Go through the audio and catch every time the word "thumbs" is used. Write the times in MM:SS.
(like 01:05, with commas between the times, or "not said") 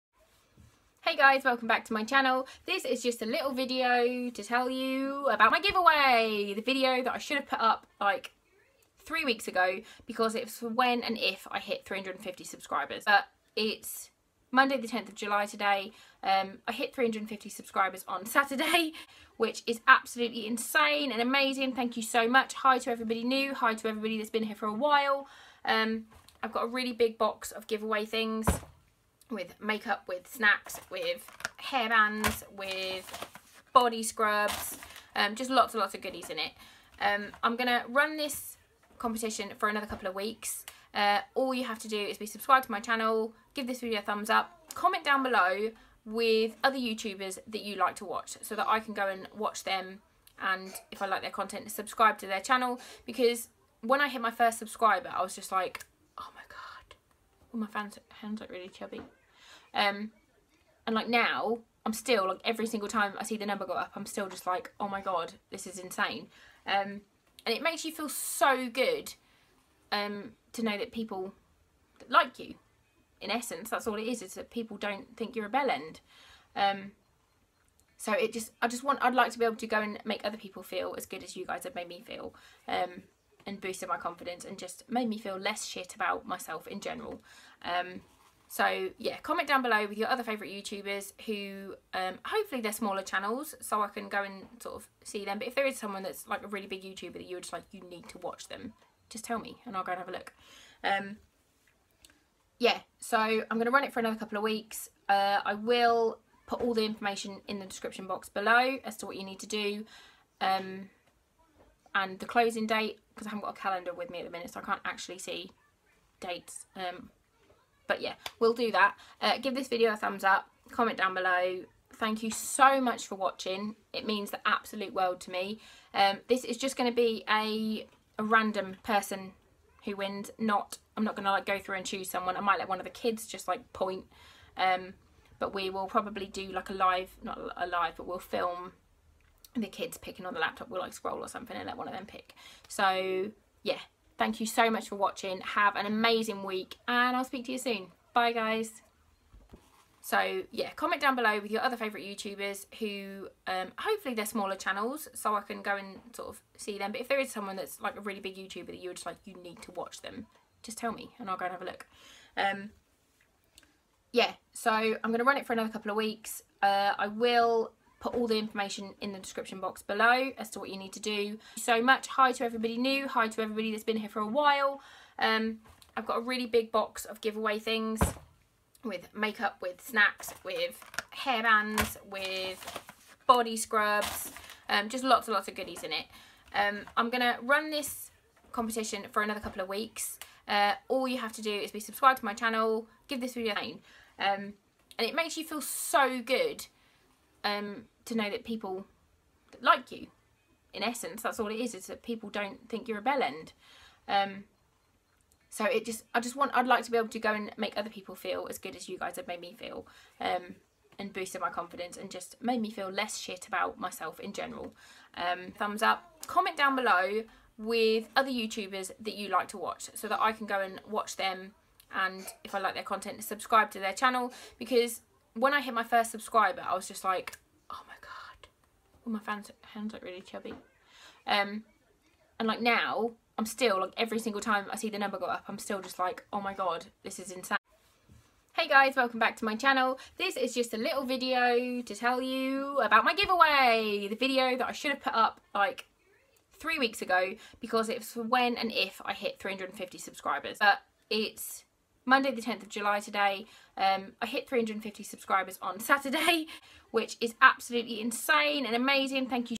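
00:44, 01:59, 03:35.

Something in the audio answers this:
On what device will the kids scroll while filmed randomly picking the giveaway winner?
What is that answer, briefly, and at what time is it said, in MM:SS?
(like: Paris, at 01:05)
laptop, at 02:20.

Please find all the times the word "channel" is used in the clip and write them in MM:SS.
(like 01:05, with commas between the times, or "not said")
00:02, 00:42, 00:52, 01:33, 02:34, 03:12, 03:43, 03:59.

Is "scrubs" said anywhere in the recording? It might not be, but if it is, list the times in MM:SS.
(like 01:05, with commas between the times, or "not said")
00:34, 03:03.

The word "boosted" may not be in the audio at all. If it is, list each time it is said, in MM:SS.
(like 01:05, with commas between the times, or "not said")
01:23, 03:31.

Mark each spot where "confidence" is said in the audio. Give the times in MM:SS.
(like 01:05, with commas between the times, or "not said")
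01:23, 03:31.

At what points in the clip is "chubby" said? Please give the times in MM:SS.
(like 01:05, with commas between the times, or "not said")
00:58, 03:50.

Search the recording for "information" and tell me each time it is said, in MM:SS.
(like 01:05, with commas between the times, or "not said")
01:46, 02:48.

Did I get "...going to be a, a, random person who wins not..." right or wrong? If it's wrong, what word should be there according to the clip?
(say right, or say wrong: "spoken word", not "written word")
right.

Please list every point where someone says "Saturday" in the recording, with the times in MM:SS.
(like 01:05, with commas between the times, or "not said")
00:18, 04:15.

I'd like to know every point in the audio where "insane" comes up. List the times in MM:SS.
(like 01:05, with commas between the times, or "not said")
00:20, 01:05, 03:57, 04:18.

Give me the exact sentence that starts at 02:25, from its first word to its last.
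Have an amazing week and I'll speak to you soon.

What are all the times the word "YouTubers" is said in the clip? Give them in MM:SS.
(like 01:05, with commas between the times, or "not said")
00:46, 01:30, 01:36, 02:32, 02:38, 03:38.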